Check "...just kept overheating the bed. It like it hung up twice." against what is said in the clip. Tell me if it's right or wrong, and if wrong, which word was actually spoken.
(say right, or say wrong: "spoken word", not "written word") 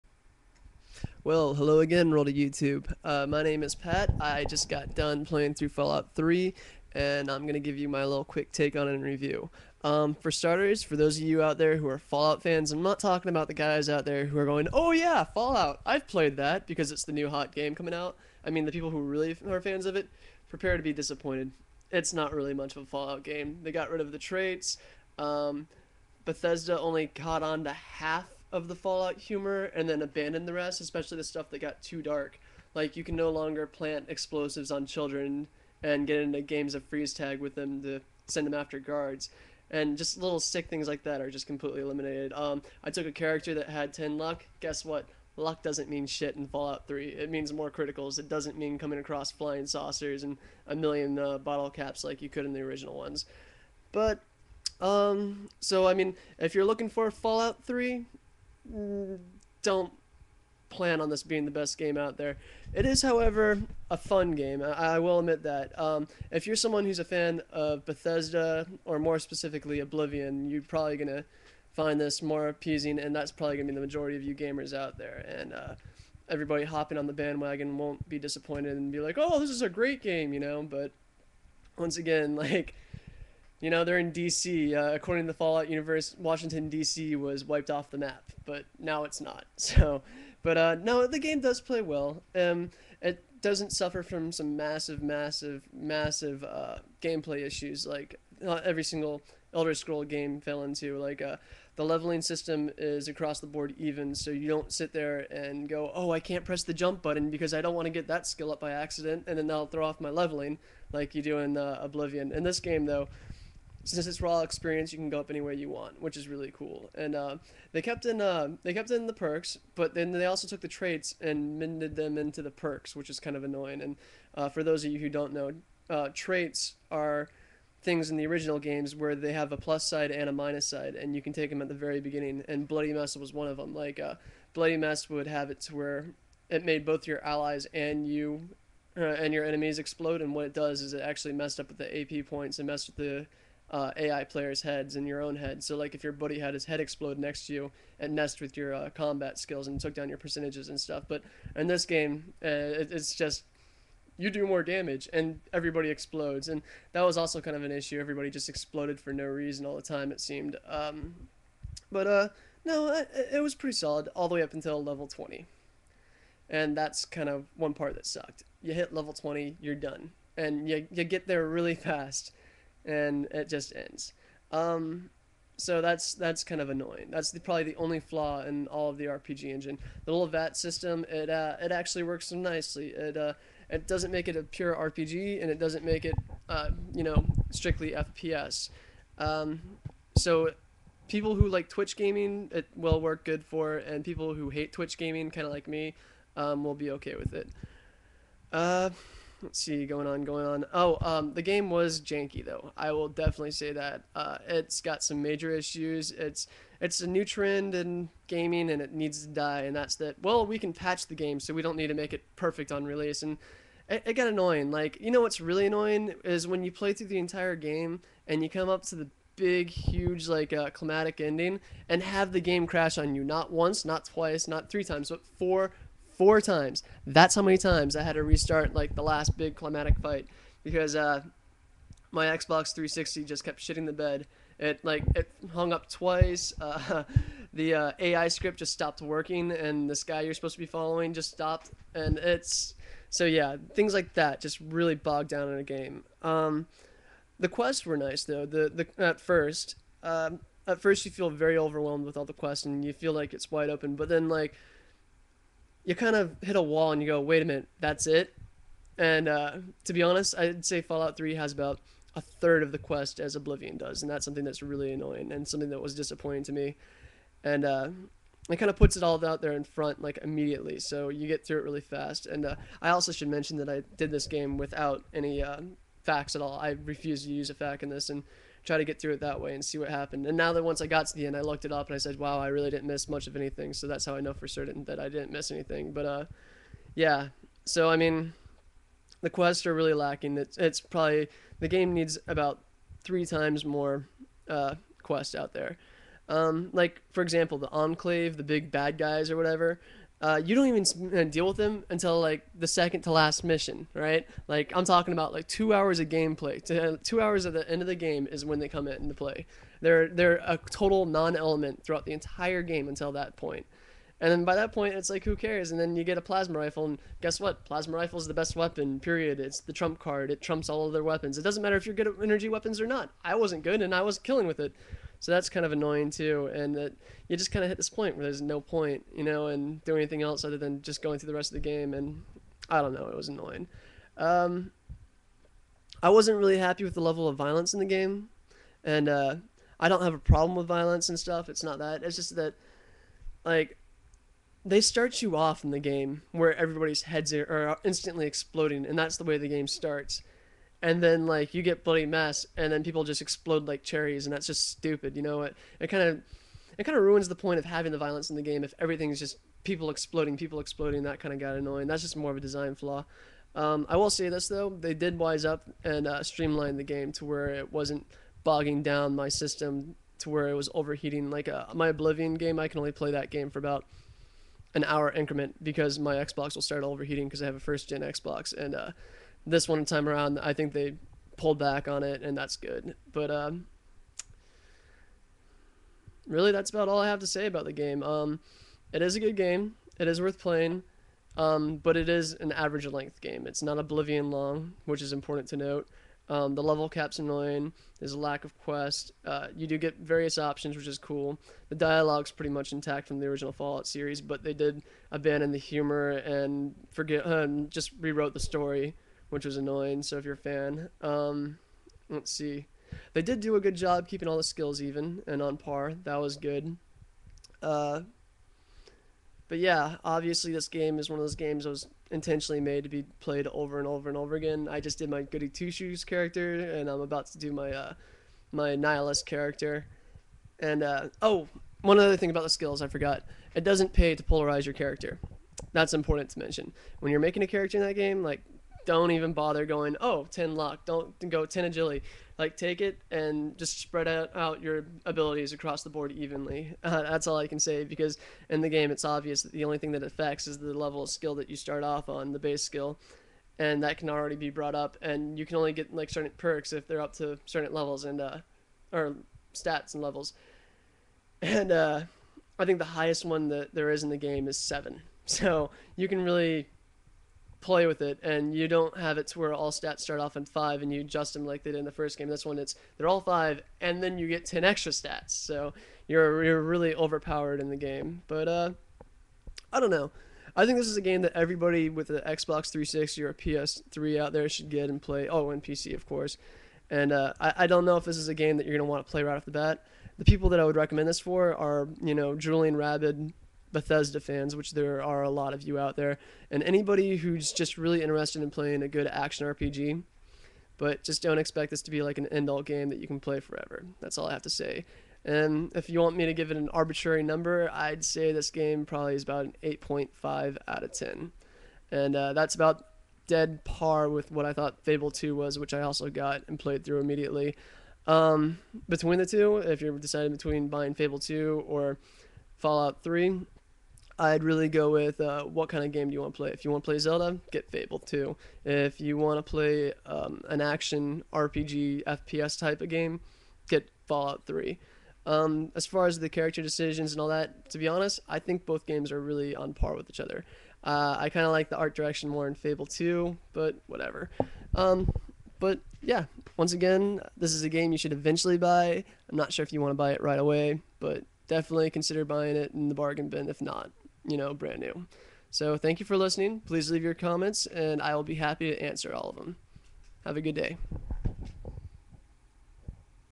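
wrong: "shitting", not "overheating".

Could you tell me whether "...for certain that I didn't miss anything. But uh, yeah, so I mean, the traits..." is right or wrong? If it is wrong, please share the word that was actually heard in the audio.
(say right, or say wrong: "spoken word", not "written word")
wrong: "quests", not "traits".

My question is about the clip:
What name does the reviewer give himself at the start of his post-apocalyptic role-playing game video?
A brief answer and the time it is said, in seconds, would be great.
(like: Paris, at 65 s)
Pat, at 3 s.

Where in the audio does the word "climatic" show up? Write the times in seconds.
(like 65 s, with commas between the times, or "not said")
220 s, 229 s.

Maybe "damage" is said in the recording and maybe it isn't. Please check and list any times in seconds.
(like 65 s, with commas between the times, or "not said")
154 s.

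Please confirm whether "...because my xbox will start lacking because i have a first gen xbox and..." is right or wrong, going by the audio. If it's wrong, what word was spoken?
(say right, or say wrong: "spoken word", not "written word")
wrong: "overheating", not "lacking".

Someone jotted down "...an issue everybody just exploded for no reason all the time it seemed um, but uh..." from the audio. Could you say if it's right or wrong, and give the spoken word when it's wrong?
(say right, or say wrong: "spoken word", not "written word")
right.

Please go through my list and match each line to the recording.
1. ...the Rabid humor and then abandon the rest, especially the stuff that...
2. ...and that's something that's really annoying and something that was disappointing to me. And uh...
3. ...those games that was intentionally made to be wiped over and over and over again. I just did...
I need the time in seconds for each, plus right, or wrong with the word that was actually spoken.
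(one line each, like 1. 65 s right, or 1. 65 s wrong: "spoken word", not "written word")
1. 28 s wrong: "Fallout", not "Rabid"
2. 264 s right
3. 421 s wrong: "played", not "wiped".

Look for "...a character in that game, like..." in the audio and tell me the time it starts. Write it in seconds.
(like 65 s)
437 s.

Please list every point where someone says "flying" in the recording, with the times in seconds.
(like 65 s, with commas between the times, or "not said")
49 s.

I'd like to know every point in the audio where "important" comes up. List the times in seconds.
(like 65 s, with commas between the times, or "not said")
395 s, 435 s.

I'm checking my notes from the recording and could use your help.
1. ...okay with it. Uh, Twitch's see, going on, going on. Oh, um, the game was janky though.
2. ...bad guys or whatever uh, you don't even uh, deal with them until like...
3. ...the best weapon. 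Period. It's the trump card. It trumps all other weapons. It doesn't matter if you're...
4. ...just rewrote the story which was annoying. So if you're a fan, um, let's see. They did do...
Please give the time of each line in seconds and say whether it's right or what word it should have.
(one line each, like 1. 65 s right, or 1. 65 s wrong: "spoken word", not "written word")
1. 196 s wrong: "Let", not "Twitch"
2. 298 s right
3. 318 s right
4. 407 s right.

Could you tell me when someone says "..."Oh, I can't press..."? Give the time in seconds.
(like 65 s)
105 s.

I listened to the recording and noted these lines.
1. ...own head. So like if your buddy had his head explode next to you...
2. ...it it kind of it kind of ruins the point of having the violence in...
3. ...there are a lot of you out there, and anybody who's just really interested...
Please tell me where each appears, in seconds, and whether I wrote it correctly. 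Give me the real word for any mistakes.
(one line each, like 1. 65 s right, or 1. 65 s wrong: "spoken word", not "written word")
1. 145 s right
2. 355 s right
3. 494 s right.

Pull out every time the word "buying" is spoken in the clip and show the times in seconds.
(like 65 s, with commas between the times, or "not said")
520 s, 552 s.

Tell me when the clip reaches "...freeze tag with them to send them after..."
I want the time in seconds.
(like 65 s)
36 s.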